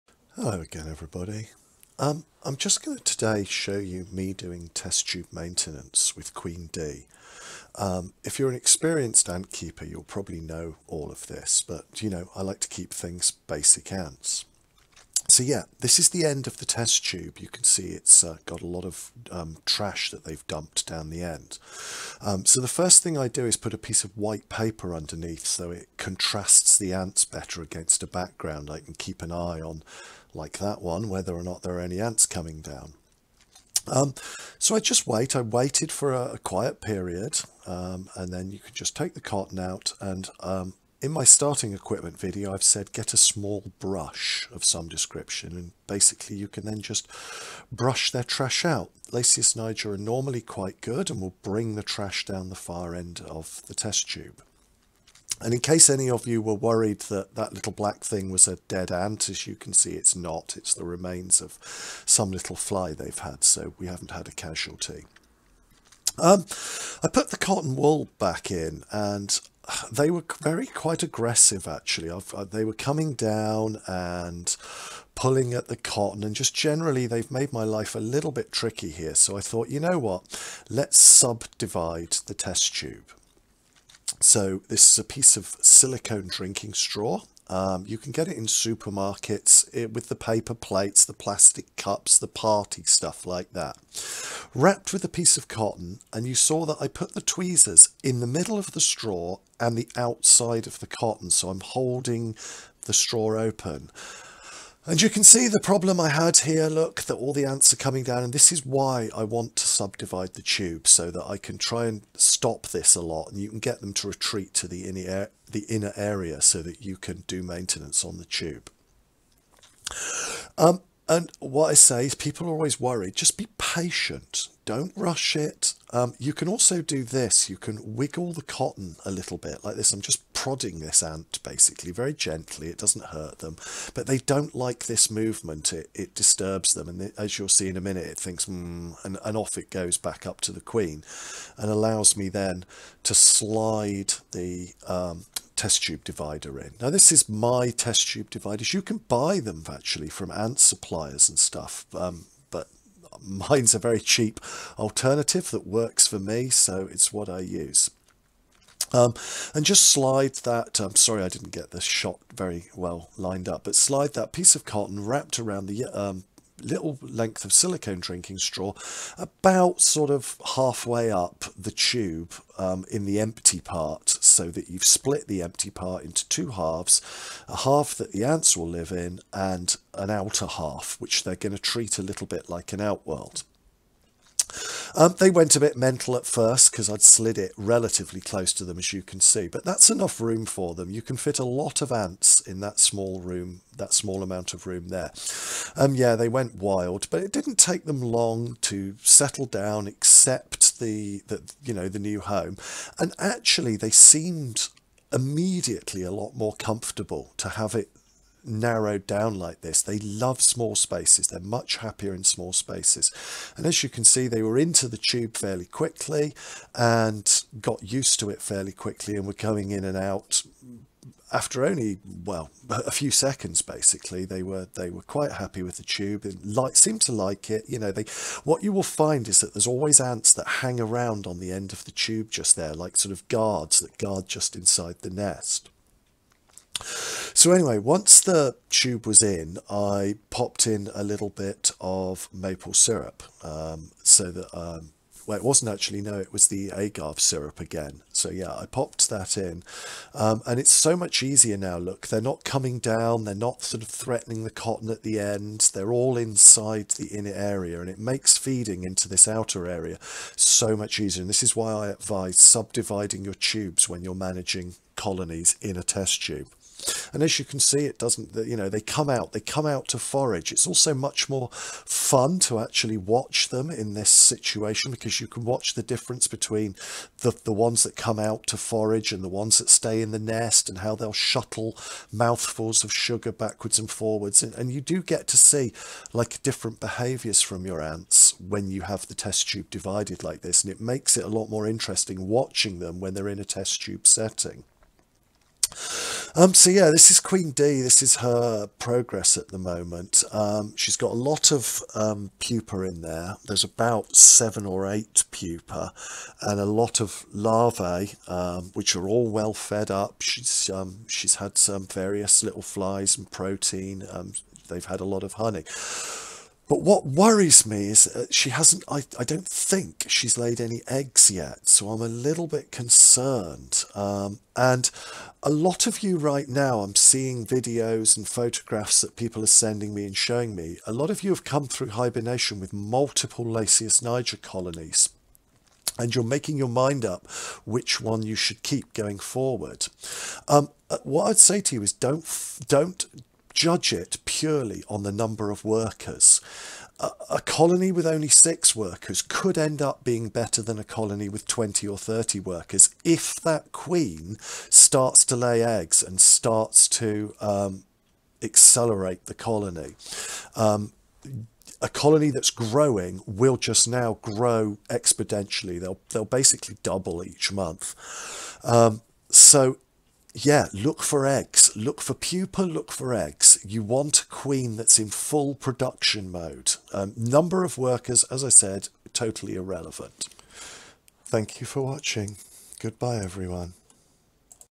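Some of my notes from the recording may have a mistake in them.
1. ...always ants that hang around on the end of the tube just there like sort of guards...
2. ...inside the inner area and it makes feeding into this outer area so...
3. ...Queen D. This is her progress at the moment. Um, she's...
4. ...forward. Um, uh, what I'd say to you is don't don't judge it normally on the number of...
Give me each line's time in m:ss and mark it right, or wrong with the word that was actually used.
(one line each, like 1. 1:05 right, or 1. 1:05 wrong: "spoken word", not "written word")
1. 3:49 right
2. 4:16 right
3. 4:57 right
4. 5:39 wrong: "purely", not "normally".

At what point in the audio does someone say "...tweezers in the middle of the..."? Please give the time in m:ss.
1:37.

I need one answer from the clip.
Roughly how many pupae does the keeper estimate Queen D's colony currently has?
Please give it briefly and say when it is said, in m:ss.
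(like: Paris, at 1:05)
7 or 8, at 5:04.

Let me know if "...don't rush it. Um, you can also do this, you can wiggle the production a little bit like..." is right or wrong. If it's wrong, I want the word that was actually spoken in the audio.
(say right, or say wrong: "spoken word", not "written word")
wrong: "cotton", not "production".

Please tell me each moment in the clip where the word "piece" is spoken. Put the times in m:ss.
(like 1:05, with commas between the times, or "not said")
0:23, 1:25, 1:35, 2:44.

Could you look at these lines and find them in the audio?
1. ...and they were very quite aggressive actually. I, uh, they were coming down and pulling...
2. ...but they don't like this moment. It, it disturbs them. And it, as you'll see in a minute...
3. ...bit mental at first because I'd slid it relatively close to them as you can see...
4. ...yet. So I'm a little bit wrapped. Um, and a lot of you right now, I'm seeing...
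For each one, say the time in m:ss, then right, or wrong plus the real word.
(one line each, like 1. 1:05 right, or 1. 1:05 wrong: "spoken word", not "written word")
1. 1:08 right
2. 2:13 wrong: "movement", not "moment"
3. 3:05 right
4. 5:21 wrong: "concerned", not "wrapped".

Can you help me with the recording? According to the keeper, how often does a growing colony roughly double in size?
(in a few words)
Each month.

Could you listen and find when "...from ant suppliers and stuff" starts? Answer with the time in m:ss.
2:30.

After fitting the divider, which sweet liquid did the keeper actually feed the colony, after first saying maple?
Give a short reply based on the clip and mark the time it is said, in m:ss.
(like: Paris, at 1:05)
Agave syrup, at 4:06.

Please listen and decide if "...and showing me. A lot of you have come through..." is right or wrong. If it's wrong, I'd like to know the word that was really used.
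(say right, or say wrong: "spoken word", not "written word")
right.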